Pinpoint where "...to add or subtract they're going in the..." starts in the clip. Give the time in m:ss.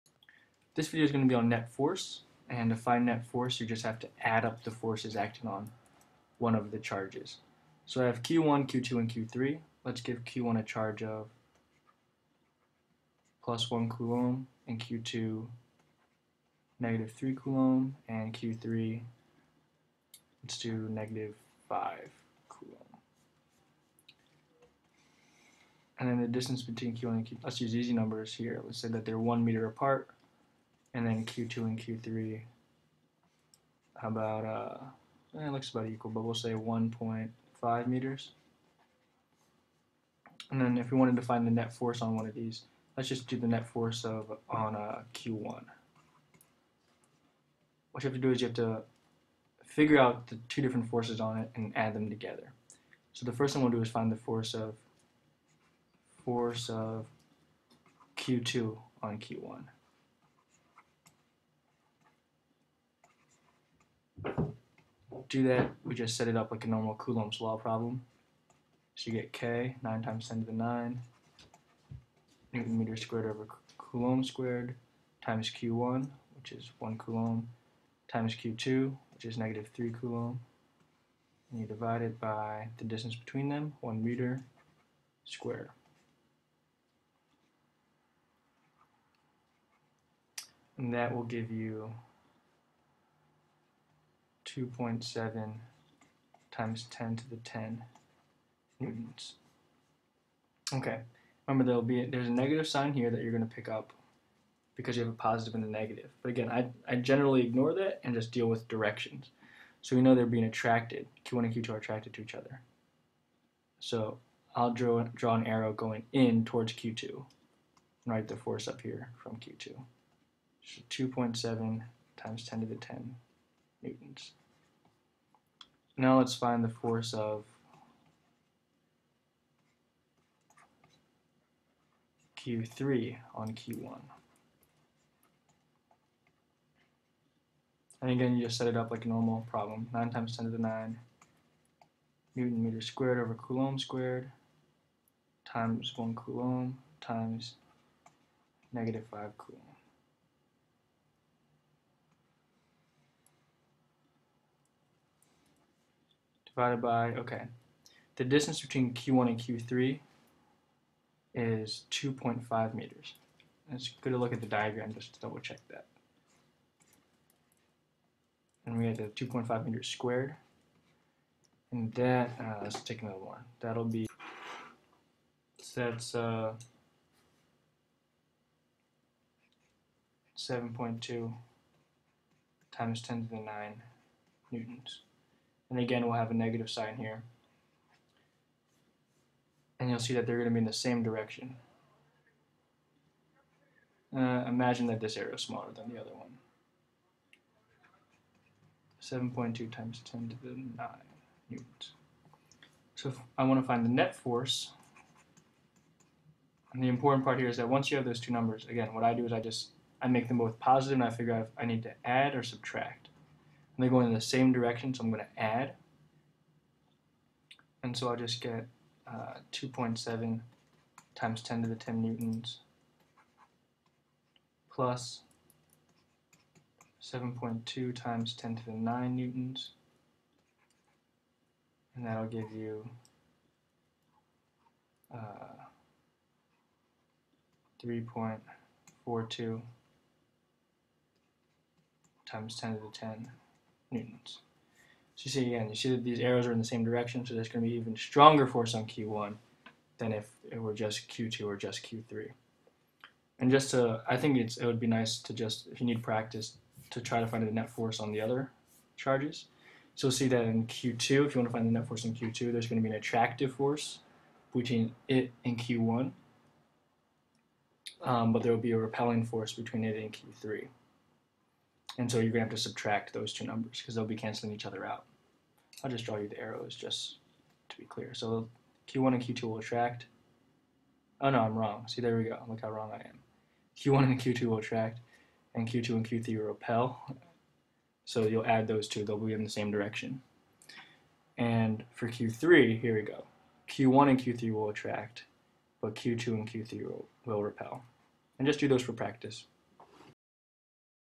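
3:31.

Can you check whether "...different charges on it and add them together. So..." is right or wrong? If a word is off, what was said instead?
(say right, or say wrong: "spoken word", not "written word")
wrong: "forces", not "charges".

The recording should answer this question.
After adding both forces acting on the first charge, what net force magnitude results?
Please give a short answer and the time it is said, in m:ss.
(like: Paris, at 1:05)
3.42 x 10^10 newtons, at 3:57.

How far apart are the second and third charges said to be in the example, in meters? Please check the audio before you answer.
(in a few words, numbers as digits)
1.5 meters.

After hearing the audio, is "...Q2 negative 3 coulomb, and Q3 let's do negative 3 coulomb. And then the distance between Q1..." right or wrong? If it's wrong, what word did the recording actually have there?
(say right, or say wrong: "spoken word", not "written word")
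wrong: "5", not "3".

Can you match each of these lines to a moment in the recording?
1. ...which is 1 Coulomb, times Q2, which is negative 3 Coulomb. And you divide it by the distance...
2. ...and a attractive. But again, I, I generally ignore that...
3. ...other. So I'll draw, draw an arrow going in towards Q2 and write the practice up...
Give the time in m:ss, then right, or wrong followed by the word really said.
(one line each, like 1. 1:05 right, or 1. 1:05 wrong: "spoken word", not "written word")
1. 1:16 right
2. 1:45 wrong: "negative", not "attractive"
3. 1:52 wrong: "force", not "practice".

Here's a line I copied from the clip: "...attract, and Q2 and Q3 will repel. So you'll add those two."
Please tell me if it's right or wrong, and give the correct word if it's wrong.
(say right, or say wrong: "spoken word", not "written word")
right.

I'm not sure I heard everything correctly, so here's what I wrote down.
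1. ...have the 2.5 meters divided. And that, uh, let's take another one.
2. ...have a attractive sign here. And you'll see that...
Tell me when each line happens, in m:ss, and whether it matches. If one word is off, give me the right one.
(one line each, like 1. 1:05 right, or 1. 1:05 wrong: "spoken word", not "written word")
1. 2:48 wrong: "squared", not "divided"
2. 3:06 wrong: "negative", not "attractive".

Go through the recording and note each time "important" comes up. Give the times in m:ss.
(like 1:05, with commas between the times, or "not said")
3:26.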